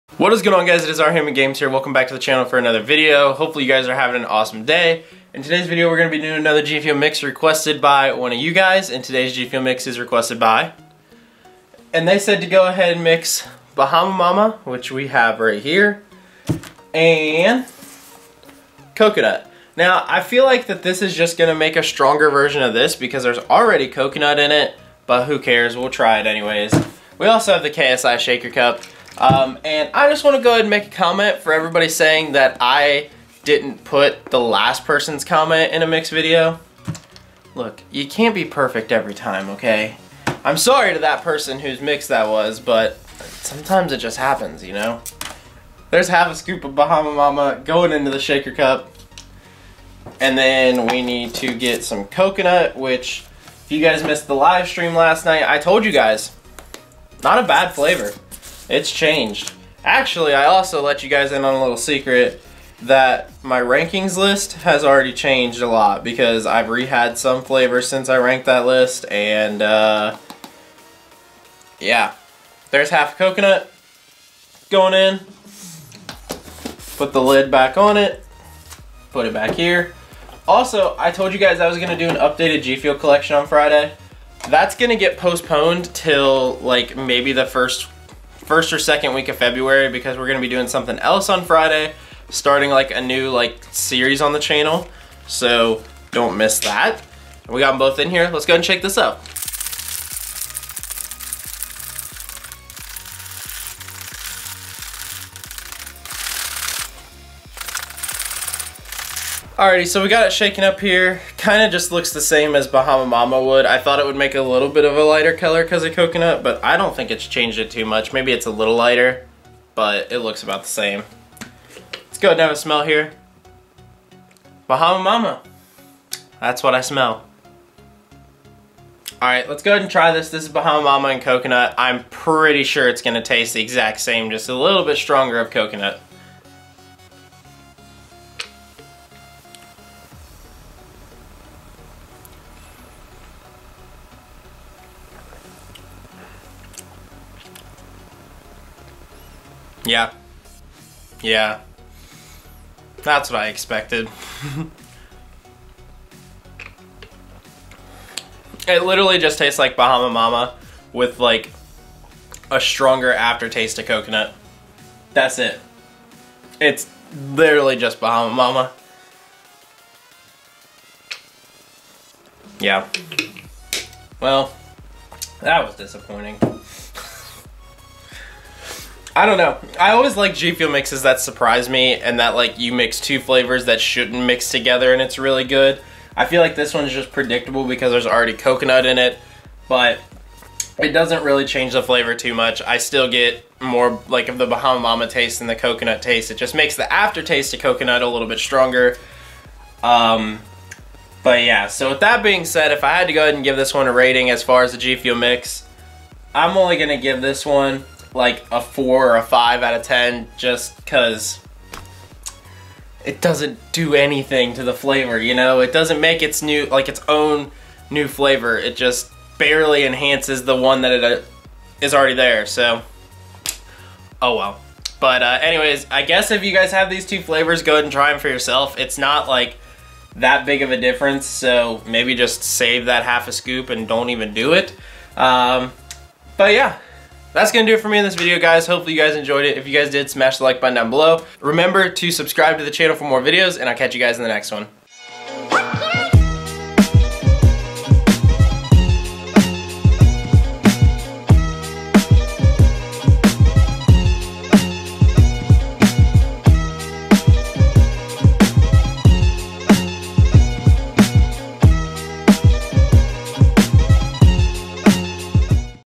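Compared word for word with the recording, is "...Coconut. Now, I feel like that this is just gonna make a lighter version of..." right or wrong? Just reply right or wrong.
wrong.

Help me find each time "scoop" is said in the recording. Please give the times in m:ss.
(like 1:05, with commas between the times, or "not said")
0:46, 3:53.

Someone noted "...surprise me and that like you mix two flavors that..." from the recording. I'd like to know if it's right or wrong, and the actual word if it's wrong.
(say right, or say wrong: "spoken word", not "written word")
right.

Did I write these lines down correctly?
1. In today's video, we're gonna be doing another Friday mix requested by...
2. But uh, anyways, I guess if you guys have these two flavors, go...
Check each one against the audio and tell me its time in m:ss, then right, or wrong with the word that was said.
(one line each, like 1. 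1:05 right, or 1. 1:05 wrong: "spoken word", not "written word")
1. 0:05 wrong: "Fuel", not "Friday"
2. 3:44 right.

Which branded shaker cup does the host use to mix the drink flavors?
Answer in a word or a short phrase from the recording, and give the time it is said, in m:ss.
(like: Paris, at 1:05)
KSI Shaker Cup, at 0:27.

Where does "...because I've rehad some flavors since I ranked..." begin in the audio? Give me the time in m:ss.
1:06.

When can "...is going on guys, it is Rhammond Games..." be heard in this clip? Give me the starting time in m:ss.
0:00.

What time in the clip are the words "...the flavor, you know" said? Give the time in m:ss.
3:34.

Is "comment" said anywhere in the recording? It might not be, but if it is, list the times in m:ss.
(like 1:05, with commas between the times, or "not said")
0:30, 0:35.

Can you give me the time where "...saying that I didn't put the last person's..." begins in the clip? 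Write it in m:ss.
0:31.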